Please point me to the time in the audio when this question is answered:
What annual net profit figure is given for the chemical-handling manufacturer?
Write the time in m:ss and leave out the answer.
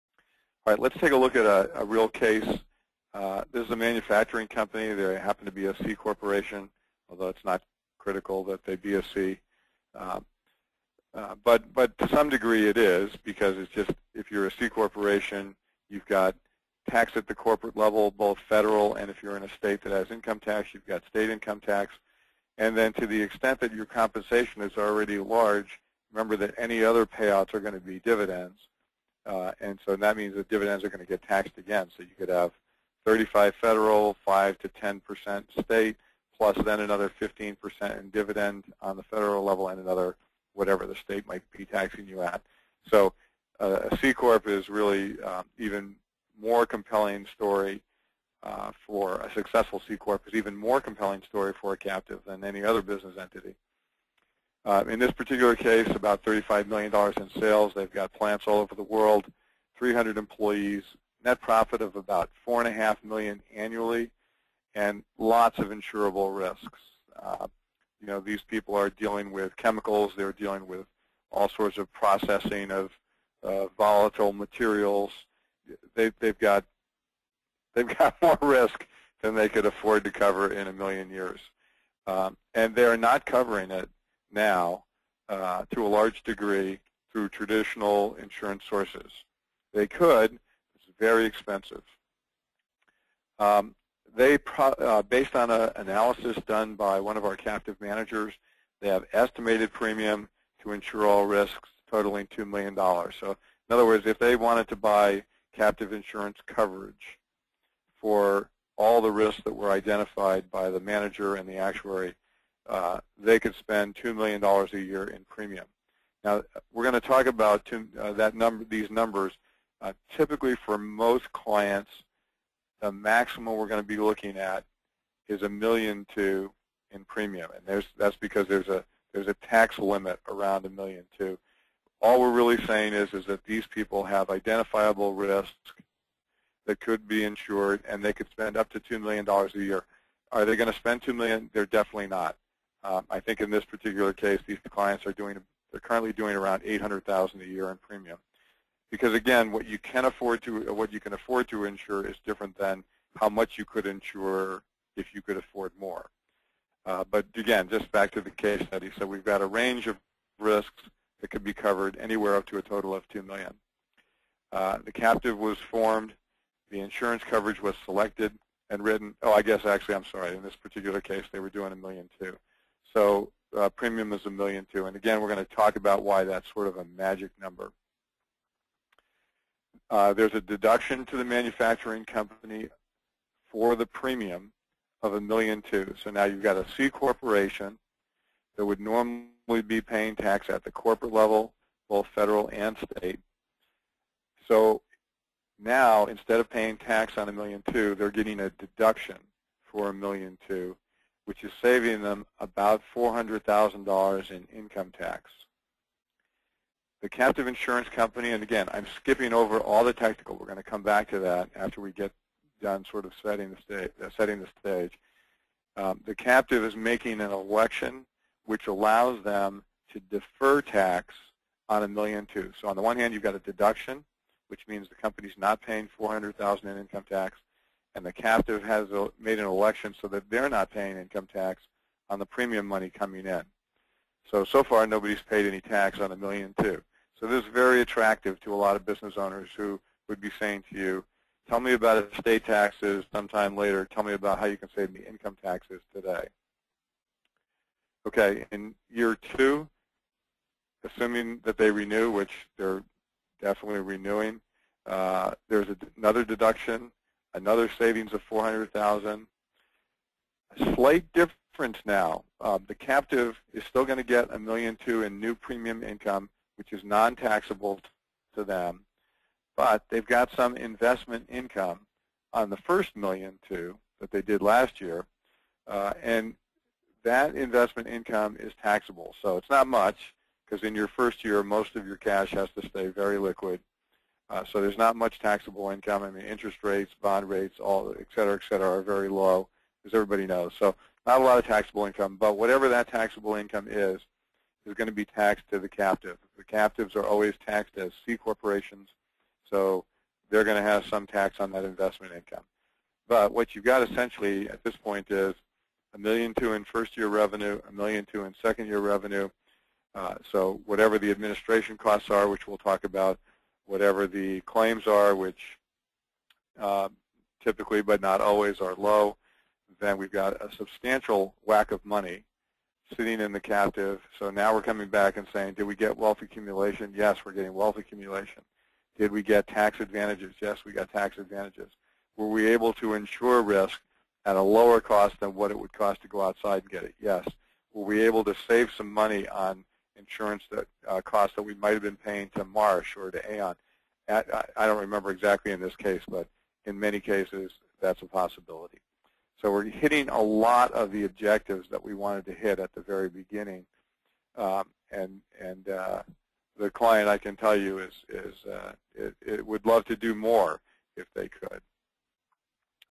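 1:02.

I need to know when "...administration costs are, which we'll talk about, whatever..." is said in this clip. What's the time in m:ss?
5:11.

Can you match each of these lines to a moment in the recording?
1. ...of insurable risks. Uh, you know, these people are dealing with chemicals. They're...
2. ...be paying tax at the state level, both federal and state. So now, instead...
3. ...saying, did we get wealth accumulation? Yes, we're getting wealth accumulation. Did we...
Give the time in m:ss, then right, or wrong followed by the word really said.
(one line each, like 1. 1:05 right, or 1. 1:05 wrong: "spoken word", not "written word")
1. 1:05 right
2. 3:09 wrong: "corporate", not "state"
3. 5:25 right.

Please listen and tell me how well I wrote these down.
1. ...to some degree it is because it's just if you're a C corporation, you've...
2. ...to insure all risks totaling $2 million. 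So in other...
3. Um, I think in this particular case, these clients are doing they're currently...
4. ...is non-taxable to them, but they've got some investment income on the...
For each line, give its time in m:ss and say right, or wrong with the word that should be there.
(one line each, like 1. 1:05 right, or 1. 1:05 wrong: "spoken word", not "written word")
1. 0:11 right
2. 1:40 right
3. 2:22 right
4. 4:26 right.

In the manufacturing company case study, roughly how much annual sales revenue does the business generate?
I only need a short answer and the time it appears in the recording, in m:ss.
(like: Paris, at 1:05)
$35 million, at 0:56.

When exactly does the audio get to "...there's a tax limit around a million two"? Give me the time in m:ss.
2:09.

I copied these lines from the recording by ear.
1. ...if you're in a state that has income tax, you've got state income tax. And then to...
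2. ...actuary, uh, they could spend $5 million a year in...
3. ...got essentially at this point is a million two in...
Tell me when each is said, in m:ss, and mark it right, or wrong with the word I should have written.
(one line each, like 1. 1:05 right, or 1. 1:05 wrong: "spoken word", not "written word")
1. 0:19 right
2. 1:51 wrong: "2", not "5"
3. 5:03 right.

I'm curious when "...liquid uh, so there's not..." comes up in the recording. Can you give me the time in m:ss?
4:43.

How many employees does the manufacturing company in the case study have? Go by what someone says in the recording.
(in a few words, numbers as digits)
300.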